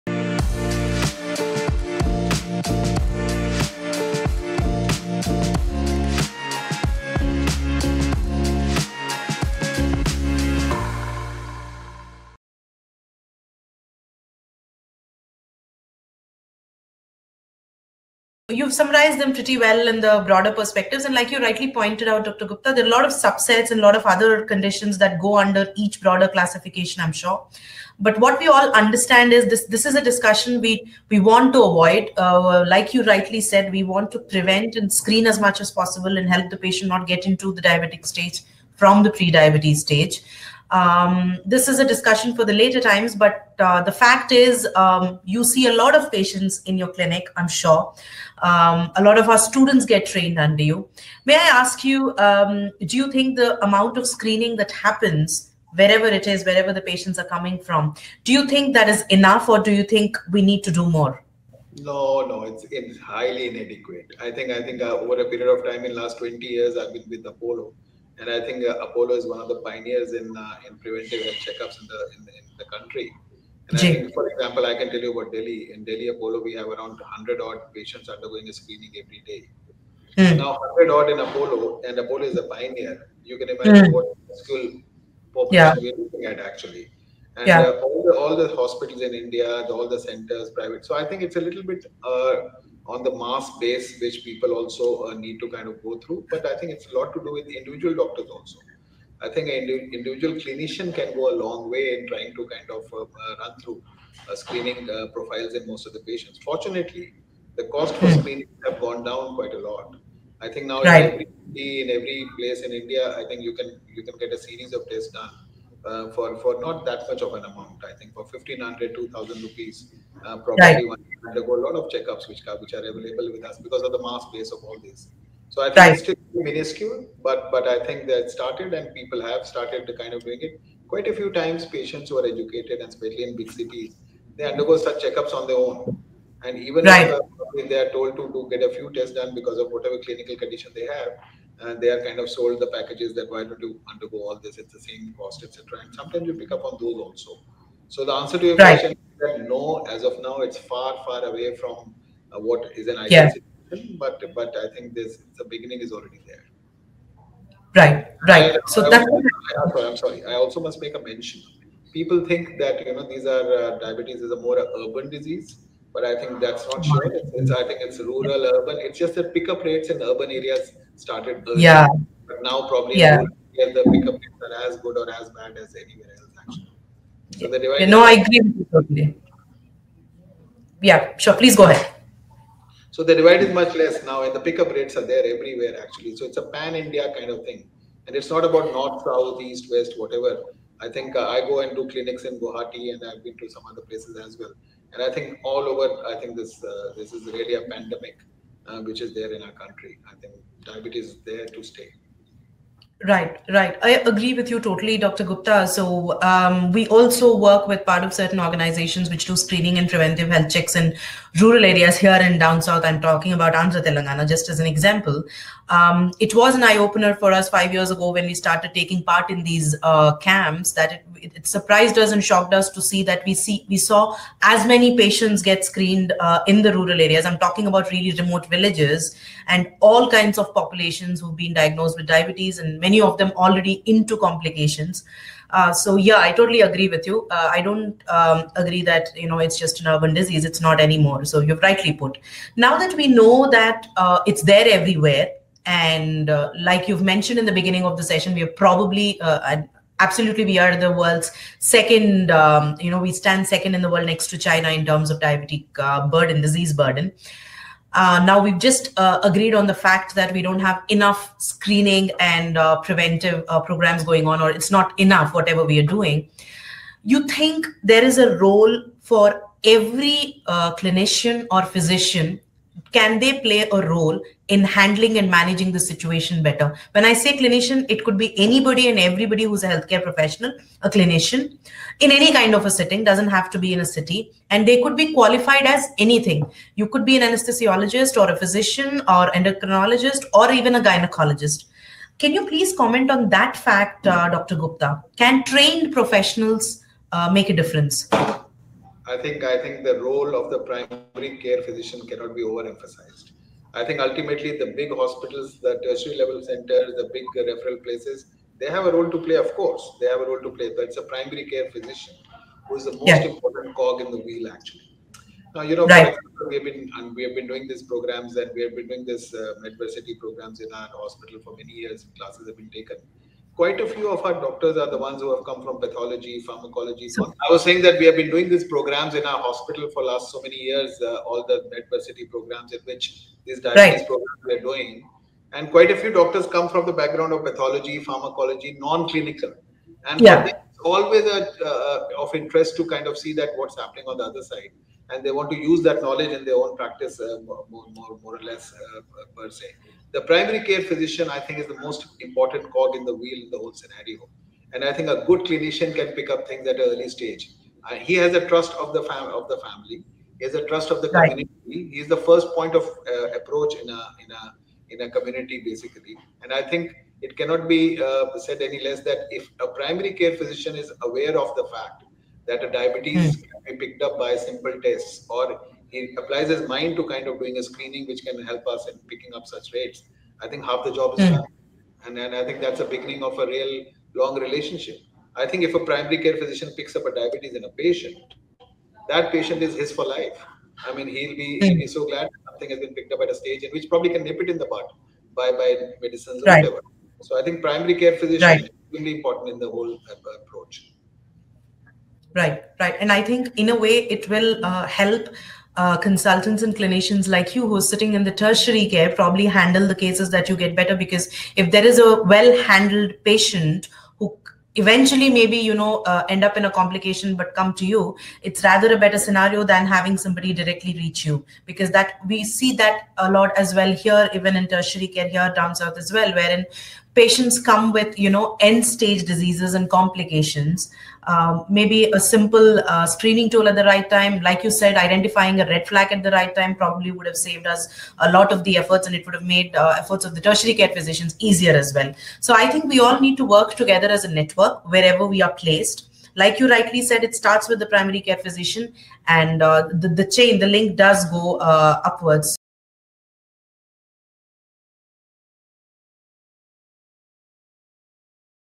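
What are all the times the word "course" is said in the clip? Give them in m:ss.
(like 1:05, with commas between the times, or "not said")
5:09.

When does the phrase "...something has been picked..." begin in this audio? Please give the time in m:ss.
6:32.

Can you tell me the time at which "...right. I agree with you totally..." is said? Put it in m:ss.
3:23.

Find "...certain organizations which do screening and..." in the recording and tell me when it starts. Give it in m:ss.
3:28.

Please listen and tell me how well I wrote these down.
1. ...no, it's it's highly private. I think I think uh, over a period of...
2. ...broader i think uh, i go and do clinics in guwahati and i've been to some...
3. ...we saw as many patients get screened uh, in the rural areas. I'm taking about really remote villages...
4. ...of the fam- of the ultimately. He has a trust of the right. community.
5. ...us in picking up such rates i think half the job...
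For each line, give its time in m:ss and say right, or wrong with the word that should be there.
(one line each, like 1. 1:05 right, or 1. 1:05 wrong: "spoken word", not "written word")
1. 1:02 wrong: "inadequate", not "private"
2. 3:09 wrong: "whatever", not "broader"
3. 3:43 wrong: "talking", not "taking"
4. 5:58 wrong: "family", not "ultimately"
5. 6:18 right.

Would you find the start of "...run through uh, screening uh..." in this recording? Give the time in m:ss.
1:43.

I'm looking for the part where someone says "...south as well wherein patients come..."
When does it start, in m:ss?
7:05.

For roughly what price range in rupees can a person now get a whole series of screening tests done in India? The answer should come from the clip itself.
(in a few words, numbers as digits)
1500 to 2000 rupees.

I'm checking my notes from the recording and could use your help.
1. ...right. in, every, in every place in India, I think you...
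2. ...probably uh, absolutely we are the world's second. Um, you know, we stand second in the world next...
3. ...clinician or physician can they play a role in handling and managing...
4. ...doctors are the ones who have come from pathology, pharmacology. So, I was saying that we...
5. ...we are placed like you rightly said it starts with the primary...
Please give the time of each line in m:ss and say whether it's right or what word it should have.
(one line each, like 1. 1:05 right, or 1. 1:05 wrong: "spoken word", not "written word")
1. 1:50 right
2. 4:08 right
3. 4:30 right
4. 5:24 right
5. 7:25 right.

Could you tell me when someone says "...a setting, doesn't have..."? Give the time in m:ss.
4:42.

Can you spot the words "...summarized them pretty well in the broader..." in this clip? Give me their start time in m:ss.
0:18.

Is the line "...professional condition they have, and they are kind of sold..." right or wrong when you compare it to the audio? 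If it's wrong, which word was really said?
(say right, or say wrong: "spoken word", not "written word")
wrong: "clinical", not "professional".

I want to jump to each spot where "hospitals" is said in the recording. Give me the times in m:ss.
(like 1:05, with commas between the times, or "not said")
1:28, 5:04, 5:20, 5:29.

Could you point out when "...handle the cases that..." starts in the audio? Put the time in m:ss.
6:49.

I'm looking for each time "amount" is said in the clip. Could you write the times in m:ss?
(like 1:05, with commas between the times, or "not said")
0:53, 1:57.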